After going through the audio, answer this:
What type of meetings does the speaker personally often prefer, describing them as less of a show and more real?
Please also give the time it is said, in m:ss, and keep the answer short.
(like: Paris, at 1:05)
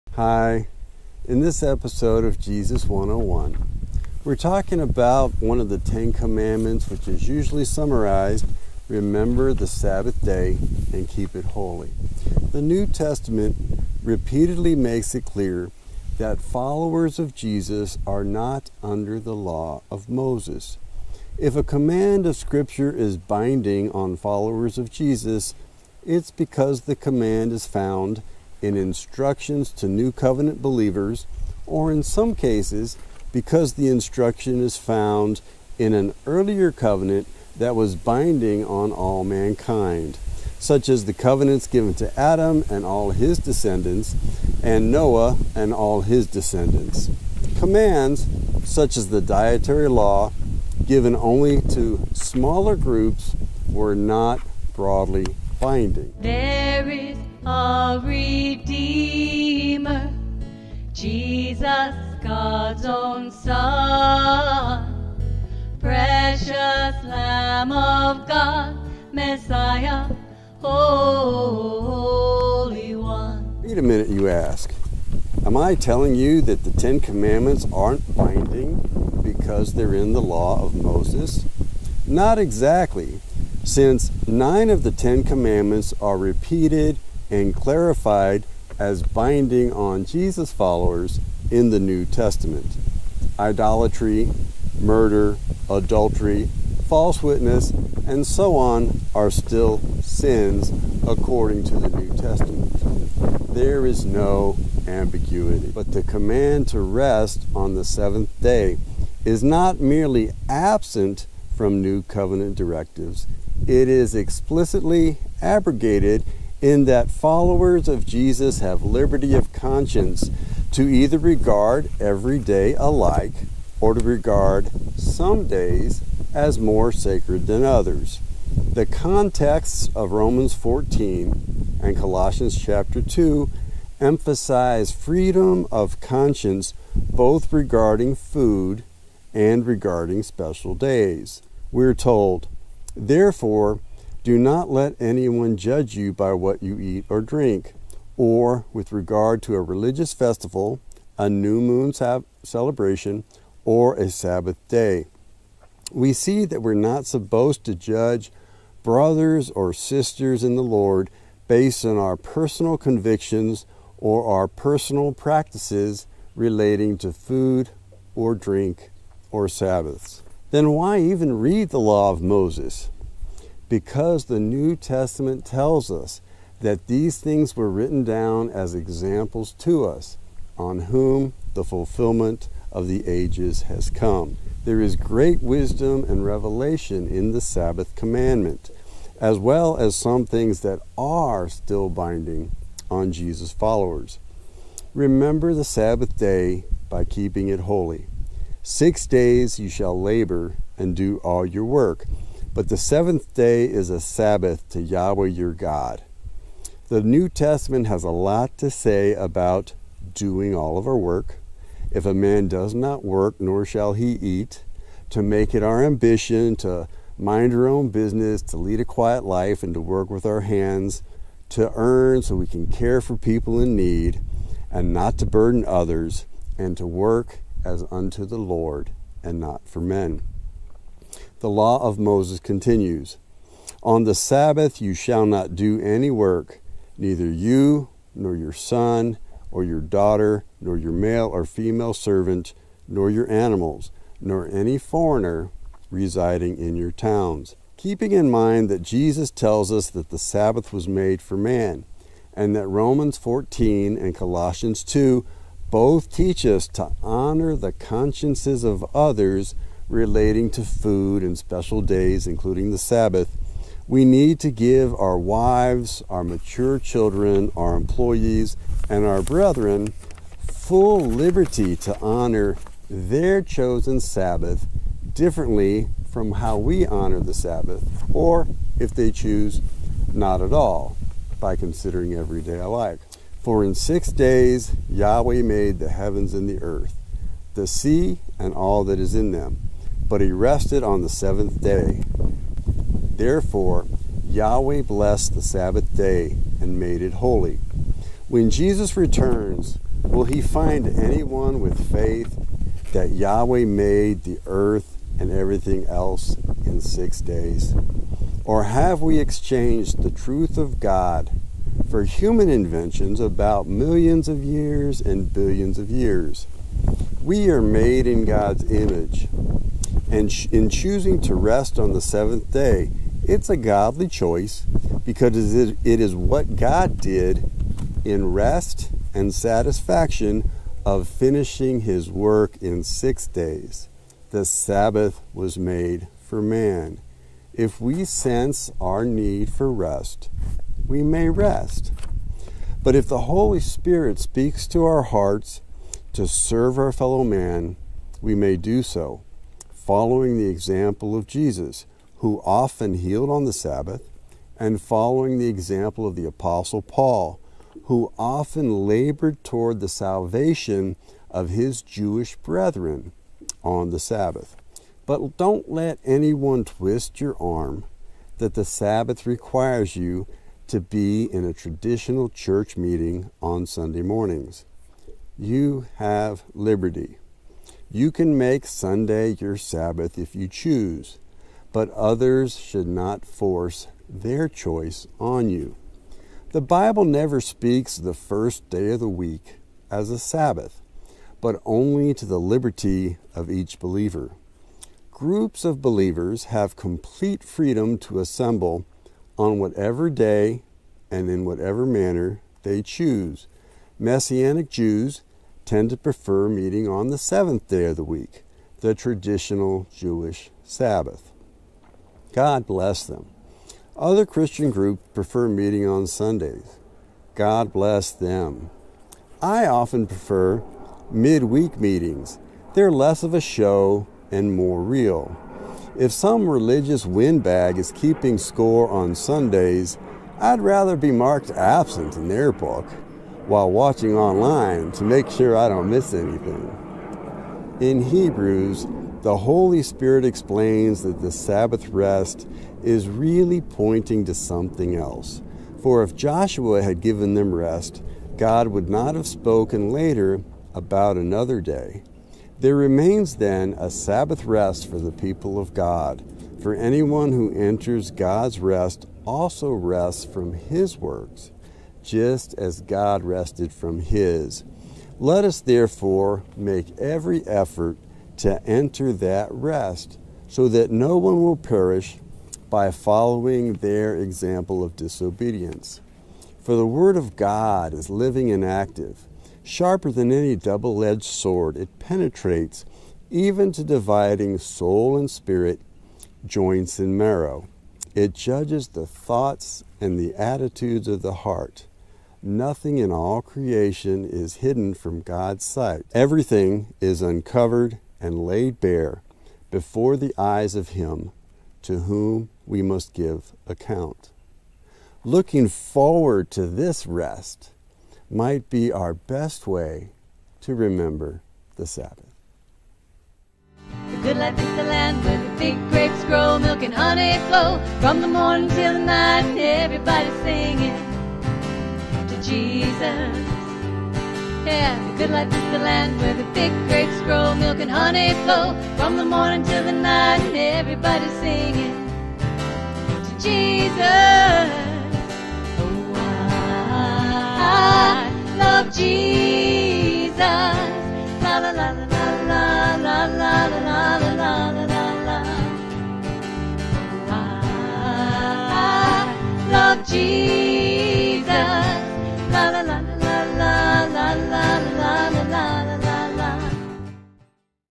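midweek meetings, at 7:01.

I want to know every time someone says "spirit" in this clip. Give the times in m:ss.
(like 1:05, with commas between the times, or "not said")
5:43, 7:19, 8:05.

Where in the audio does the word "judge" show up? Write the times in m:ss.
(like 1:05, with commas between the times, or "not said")
2:25, 2:37, 8:08.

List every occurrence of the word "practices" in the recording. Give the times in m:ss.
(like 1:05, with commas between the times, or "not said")
2:45.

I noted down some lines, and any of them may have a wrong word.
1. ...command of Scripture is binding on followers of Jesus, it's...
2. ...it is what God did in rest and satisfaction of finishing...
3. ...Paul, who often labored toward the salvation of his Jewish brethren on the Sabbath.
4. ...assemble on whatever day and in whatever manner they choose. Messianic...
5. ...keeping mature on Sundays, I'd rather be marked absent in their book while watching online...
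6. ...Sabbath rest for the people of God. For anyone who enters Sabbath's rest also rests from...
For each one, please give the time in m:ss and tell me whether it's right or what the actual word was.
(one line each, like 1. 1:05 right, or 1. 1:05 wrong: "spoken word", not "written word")
1. 0:21 right
2. 5:25 right
3. 5:56 right
4. 6:38 right
5. 7:07 wrong: "score", not "mature"
6. 7:33 wrong: "God", not "Sabbath".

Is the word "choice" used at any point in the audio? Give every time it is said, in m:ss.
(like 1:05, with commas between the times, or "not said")
5:24, 6:24.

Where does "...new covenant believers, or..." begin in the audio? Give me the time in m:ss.
0:29.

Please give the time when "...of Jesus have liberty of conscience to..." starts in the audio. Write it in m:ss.
1:57.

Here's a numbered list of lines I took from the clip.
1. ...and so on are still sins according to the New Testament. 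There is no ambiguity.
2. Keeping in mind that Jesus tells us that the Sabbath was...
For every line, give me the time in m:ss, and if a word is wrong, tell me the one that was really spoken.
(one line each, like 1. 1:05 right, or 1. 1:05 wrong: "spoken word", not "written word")
1. 1:38 right
2. 4:07 right.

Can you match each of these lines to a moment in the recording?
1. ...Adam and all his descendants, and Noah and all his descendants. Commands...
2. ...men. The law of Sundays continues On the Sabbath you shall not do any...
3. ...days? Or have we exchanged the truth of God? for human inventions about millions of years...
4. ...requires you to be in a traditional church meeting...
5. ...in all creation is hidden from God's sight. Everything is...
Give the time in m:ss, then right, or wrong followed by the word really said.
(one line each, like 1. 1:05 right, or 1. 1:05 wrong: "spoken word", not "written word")
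1. 0:42 right
2. 3:49 wrong: "Moses", not "Sundays"
3. 5:07 right
4. 6:09 right
5. 8:12 right.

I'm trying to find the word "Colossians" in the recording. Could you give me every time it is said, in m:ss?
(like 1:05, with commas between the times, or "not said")
2:11, 4:14.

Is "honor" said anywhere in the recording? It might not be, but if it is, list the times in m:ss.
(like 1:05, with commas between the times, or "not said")
4:17, 4:31, 4:36.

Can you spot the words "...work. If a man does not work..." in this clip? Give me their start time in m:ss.
3:30.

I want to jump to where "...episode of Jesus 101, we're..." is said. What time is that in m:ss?
0:01.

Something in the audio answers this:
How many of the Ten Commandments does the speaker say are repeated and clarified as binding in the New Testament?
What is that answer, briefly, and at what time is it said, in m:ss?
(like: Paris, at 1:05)
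9, at 1:24.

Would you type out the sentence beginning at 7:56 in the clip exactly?
For the Word of God is living and active sharper than any double edged sword.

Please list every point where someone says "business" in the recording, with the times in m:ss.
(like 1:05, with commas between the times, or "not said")
3:37.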